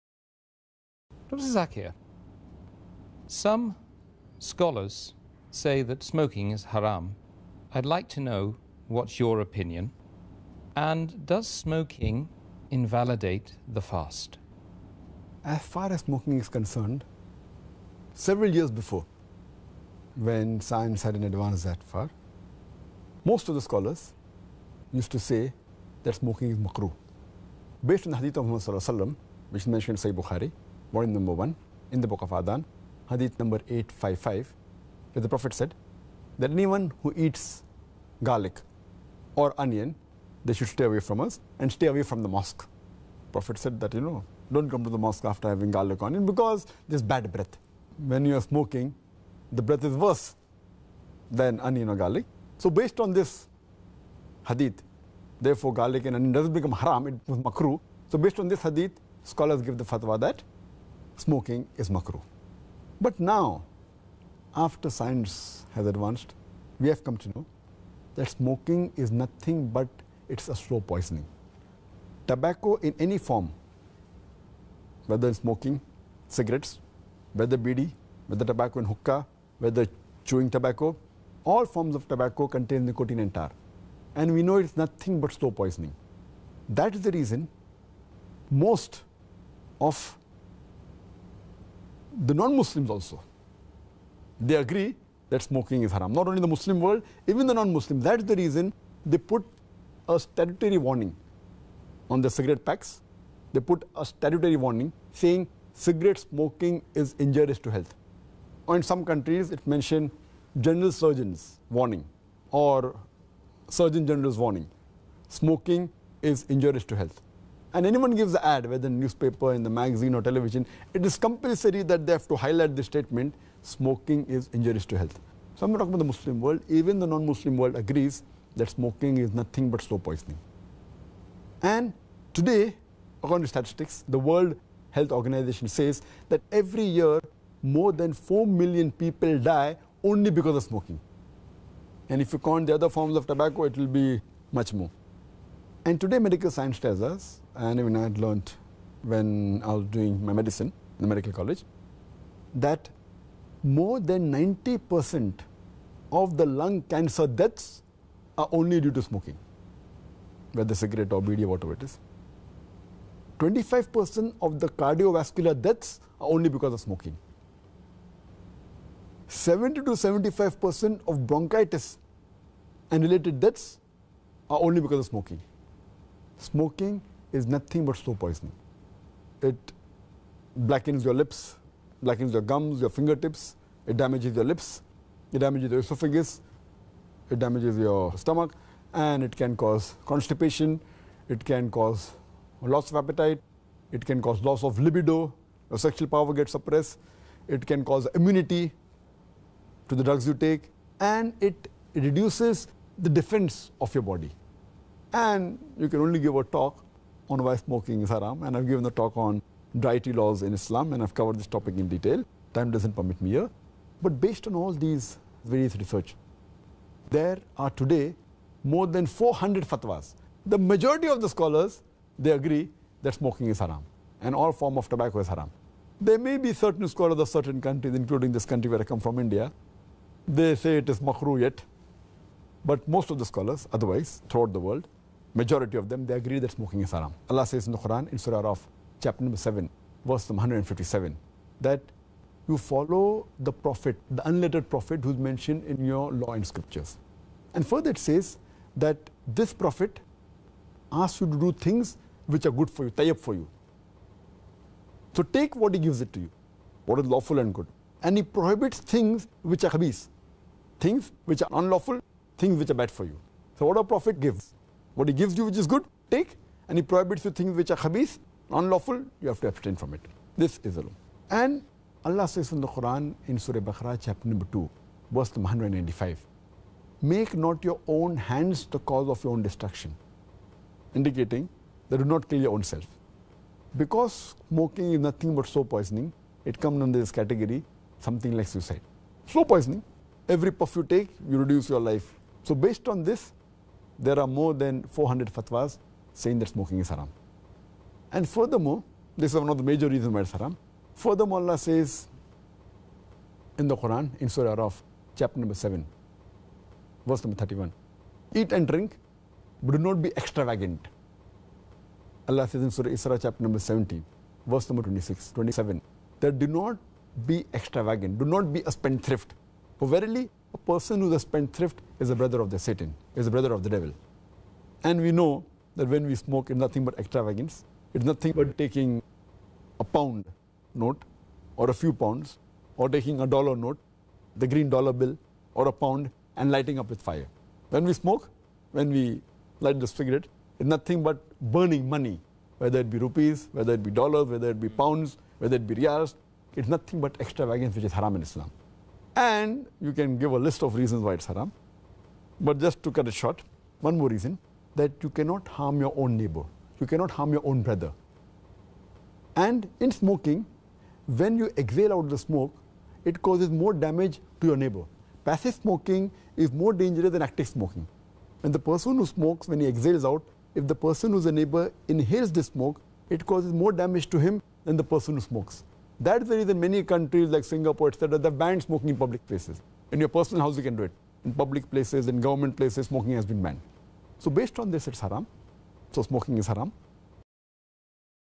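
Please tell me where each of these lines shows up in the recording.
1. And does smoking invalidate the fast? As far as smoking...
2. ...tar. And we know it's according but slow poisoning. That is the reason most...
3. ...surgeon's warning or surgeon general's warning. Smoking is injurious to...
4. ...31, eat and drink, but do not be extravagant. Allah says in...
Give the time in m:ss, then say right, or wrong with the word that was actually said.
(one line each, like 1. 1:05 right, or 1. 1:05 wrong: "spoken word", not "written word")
1. 0:10 right
2. 1:23 wrong: "nothing", not "according"
3. 1:50 right
4. 5:07 right.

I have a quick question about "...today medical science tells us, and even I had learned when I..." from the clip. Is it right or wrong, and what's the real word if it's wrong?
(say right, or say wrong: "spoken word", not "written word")
right.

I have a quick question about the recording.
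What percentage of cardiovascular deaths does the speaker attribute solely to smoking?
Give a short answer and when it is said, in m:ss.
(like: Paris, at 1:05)
25%, at 2:43.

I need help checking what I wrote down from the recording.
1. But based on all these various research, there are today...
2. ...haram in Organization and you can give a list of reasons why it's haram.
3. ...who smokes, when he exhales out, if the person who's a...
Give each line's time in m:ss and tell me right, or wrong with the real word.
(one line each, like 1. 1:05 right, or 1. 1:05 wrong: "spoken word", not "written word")
1. 3:34 right
2. 5:47 wrong: "Islam", not "Organization"
3. 6:08 right.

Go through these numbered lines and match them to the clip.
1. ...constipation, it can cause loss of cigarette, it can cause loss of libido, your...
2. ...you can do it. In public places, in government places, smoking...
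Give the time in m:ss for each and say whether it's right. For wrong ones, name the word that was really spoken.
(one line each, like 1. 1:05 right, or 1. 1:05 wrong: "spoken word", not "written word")
1. 3:10 wrong: "appetite", not "cigarette"
2. 6:20 right.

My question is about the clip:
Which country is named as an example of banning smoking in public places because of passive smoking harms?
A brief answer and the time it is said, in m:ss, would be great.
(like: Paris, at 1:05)
Singapore, at 6:17.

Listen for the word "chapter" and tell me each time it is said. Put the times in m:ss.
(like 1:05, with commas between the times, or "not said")
3:59, 4:34, 5:05, 5:13.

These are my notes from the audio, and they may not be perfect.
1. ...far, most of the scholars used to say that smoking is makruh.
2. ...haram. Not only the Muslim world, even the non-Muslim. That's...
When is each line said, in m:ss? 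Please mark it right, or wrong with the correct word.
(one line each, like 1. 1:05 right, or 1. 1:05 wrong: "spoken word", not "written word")
1. 0:21 right
2. 1:35 right.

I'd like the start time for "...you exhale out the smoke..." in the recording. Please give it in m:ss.
6:01.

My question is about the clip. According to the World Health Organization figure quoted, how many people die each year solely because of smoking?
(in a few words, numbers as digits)
more than 4 million.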